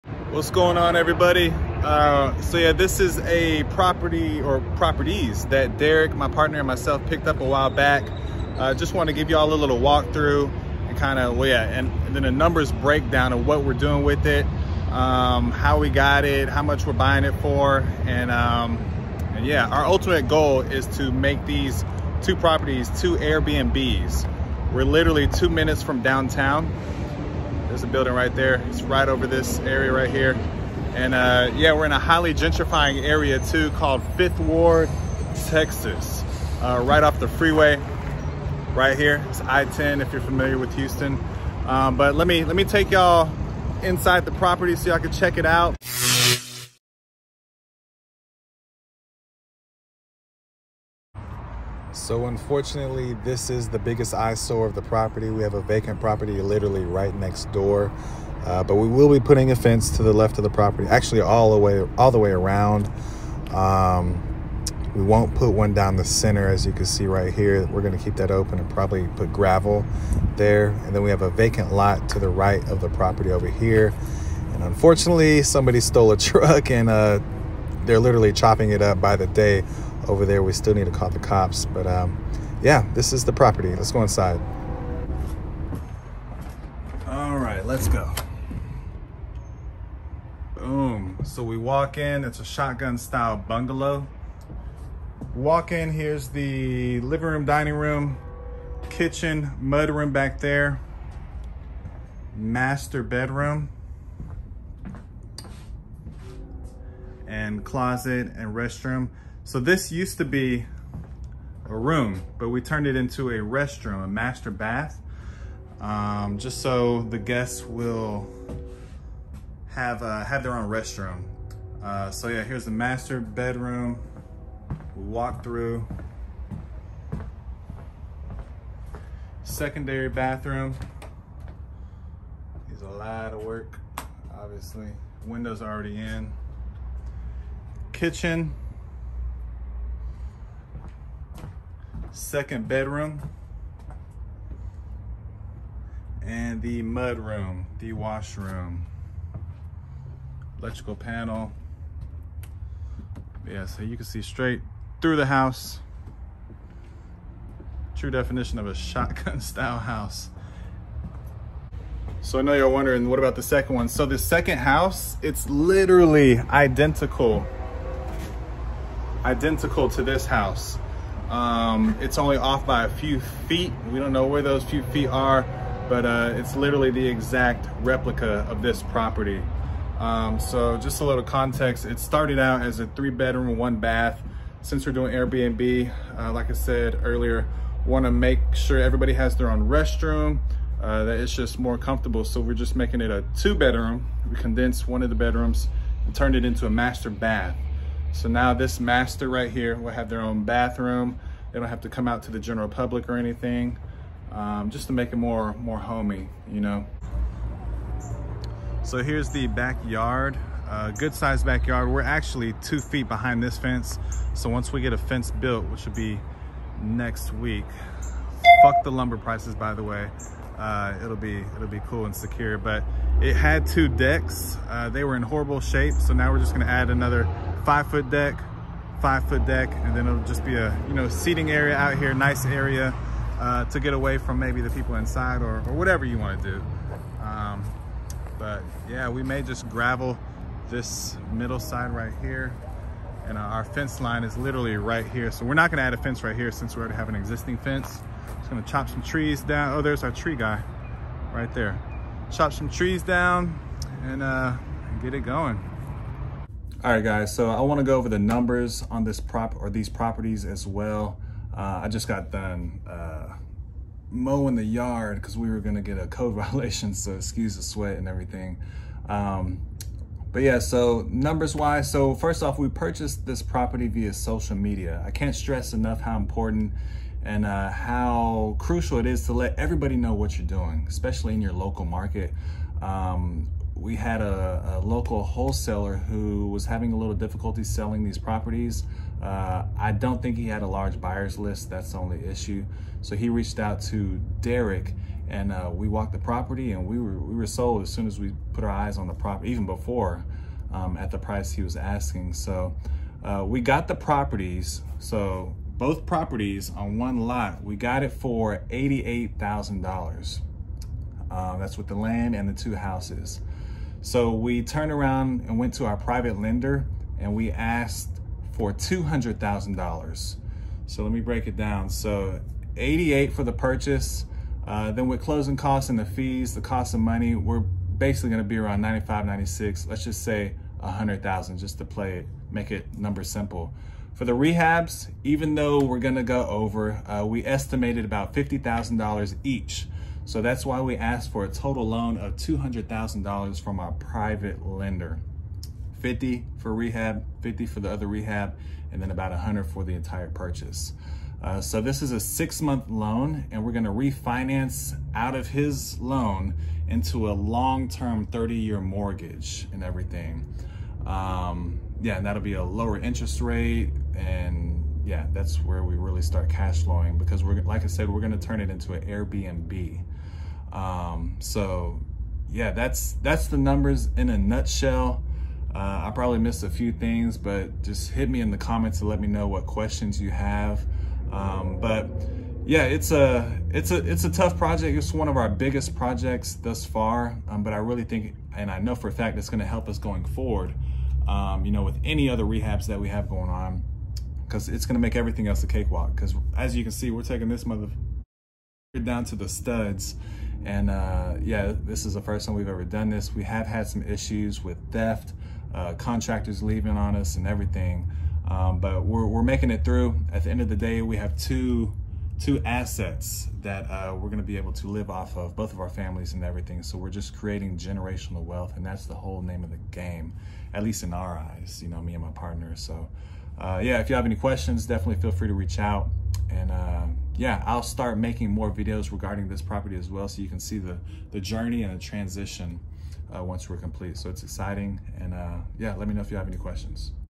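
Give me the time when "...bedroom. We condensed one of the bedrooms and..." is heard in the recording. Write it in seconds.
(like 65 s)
193 s.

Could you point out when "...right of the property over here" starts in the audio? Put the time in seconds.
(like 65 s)
72 s.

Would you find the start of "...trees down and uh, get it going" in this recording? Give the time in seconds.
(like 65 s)
252 s.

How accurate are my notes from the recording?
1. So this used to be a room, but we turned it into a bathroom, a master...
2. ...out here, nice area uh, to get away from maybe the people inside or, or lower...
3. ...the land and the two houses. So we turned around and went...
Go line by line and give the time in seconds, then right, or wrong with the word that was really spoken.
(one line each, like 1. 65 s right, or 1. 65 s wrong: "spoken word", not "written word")
1. 109 s wrong: "restroom", not "bathroom"
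2. 231 s wrong: "whatever", not "lower"
3. 311 s right.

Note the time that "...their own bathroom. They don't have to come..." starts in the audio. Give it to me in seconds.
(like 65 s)
200 s.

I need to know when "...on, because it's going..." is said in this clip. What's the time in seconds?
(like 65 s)
393 s.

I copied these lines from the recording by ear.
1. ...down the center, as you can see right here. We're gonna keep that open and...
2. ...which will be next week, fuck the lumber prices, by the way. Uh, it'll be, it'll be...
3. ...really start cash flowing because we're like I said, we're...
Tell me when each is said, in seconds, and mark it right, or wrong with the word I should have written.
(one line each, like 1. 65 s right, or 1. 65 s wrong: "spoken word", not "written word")
1. 65 s right
2. 215 s right
3. 365 s right.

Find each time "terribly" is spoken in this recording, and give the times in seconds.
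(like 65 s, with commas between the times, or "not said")
not said.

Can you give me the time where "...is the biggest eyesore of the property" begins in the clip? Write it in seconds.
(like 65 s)
53 s.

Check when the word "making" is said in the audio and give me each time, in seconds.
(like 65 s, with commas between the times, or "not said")
192 s, 409 s, 428 s.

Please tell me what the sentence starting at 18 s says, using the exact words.
And, um, and yeah, our ultimate goal is to make these two properties, two Airbnbs.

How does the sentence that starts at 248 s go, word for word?
Just gonna chop some trees down.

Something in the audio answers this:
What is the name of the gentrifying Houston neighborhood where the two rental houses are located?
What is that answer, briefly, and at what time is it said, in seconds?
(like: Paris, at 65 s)
Fifth Ward, at 34 s.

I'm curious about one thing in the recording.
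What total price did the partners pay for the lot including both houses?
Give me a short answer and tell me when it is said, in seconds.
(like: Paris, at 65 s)
$88,000, at 308 s.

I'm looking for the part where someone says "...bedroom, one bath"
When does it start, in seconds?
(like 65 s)
183 s.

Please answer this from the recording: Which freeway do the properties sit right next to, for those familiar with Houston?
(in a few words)
I-10.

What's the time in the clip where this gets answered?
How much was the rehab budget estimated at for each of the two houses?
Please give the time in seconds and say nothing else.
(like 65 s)
338 s.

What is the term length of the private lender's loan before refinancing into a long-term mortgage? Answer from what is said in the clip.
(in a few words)
6 months.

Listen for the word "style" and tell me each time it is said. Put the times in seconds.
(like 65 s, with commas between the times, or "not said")
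92 s, 159 s.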